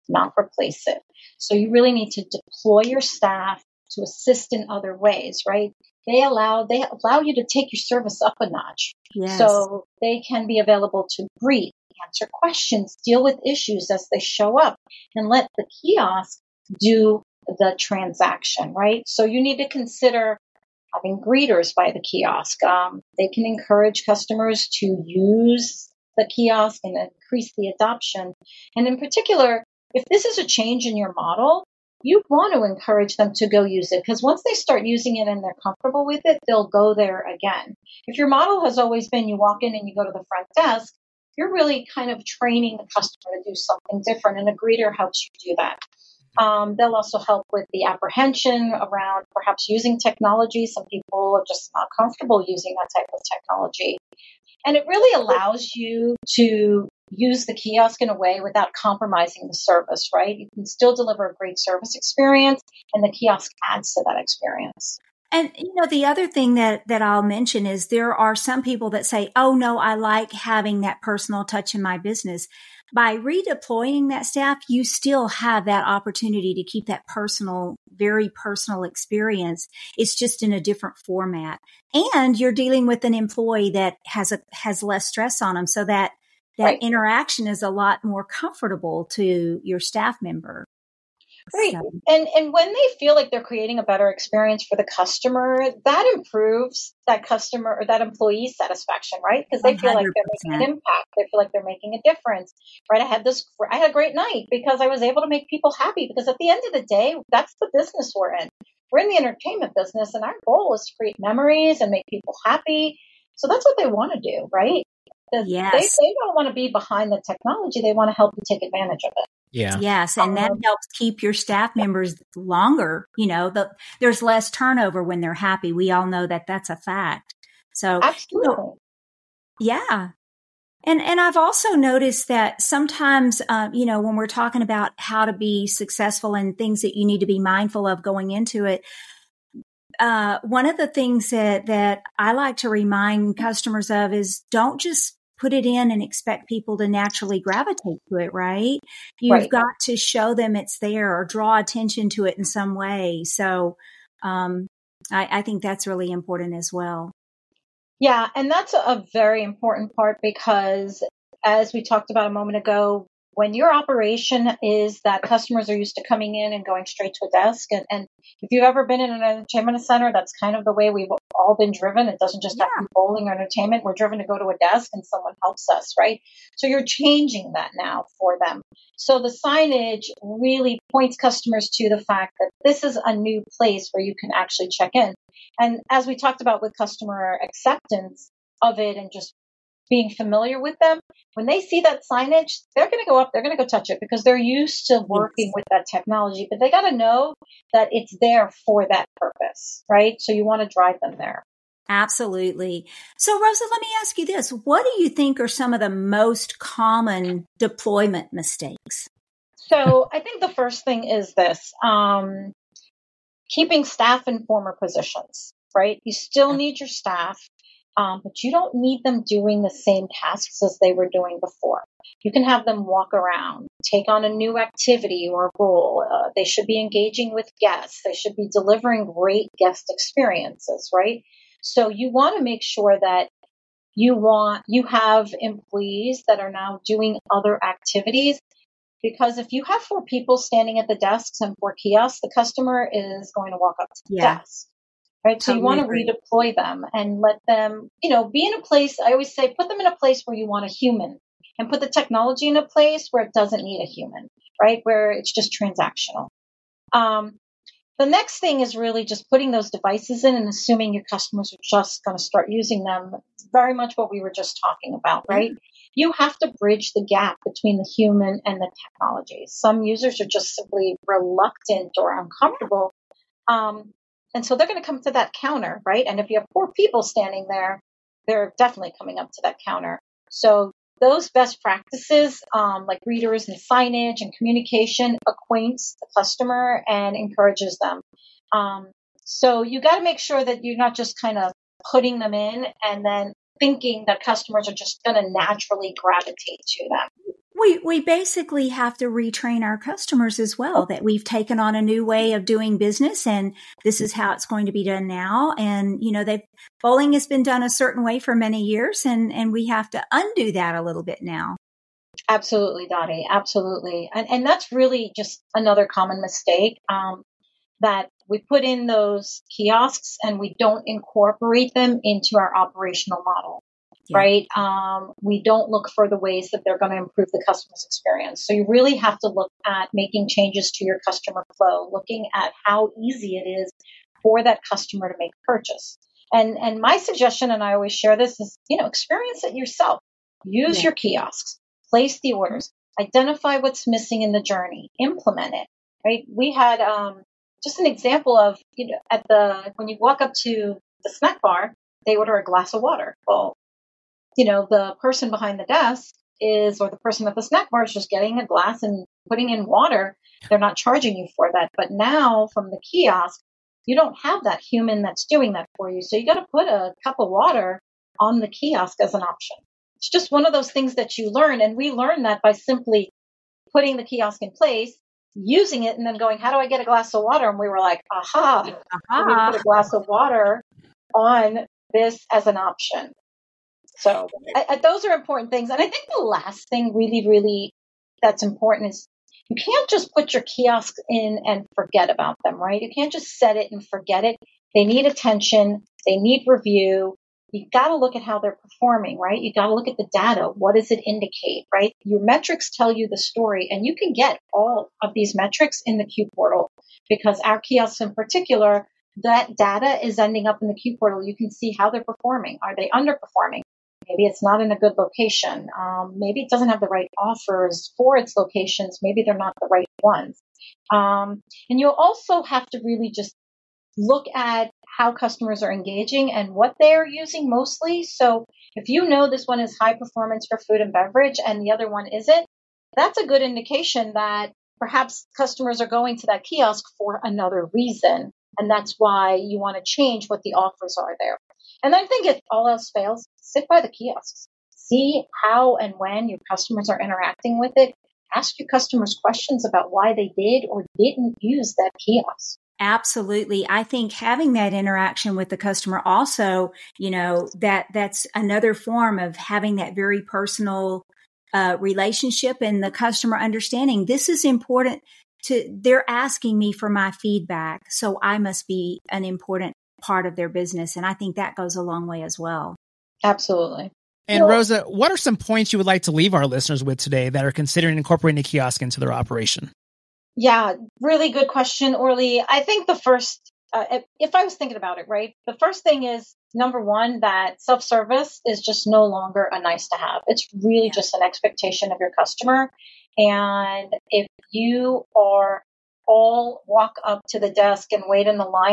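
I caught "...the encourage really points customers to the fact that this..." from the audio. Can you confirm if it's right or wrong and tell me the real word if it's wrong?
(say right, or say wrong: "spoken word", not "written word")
wrong: "signage", not "encourage".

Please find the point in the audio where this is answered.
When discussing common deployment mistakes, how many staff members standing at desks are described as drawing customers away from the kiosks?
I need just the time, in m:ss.
3:59.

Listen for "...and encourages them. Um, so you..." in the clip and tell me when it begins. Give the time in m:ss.
4:46.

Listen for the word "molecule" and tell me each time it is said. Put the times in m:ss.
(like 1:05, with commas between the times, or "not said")
not said.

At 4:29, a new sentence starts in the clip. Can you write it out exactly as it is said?
Some users are just simply reluctant or uncomfortable um, and so they're going to come to that counter, right?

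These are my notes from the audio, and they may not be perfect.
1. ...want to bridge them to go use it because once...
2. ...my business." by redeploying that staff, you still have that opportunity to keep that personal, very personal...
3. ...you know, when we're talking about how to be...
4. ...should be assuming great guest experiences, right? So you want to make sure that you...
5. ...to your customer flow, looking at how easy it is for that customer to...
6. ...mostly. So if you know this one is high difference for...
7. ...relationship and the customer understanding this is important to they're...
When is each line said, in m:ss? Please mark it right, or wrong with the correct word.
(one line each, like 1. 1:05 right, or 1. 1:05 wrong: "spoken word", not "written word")
1. 0:32 wrong: "encourage", not "bridge"
2. 1:11 right
3. 2:13 right
4. 3:48 wrong: "delivering", not "assuming"
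5. 5:30 right
6. 7:07 wrong: "performance", not "difference"
7. 7:41 right.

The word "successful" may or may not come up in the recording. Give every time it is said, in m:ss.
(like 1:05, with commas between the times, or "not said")
2:15.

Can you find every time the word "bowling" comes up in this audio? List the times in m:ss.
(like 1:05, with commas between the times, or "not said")
2:52, 5:06.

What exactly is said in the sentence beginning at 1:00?
You can still deliver a great service experience, and the kiosk adds to that experience.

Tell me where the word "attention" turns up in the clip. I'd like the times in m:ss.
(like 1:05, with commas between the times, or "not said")
2:31, 6:35.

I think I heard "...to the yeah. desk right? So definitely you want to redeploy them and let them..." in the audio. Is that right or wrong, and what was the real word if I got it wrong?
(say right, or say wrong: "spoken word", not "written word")
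wrong: "totally", not "definitely".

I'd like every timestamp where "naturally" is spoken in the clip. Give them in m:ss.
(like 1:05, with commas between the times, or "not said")
2:26, 4:55.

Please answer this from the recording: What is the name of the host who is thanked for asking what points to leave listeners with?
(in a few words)
Orly.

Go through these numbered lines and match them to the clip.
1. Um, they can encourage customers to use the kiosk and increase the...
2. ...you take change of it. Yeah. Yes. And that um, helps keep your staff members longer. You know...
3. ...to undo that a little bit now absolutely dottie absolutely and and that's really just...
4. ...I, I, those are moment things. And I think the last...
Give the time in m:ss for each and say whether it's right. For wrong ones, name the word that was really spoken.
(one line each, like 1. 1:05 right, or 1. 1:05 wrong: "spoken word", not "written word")
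1. 0:22 right
2. 1:58 wrong: "advantage", not "change"
3. 5:09 right
4. 6:24 wrong: "important", not "moment".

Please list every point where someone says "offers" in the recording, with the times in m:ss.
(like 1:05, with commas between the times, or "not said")
6:57, 7:20.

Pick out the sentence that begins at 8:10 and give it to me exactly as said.
It's really just an expectation of your customer.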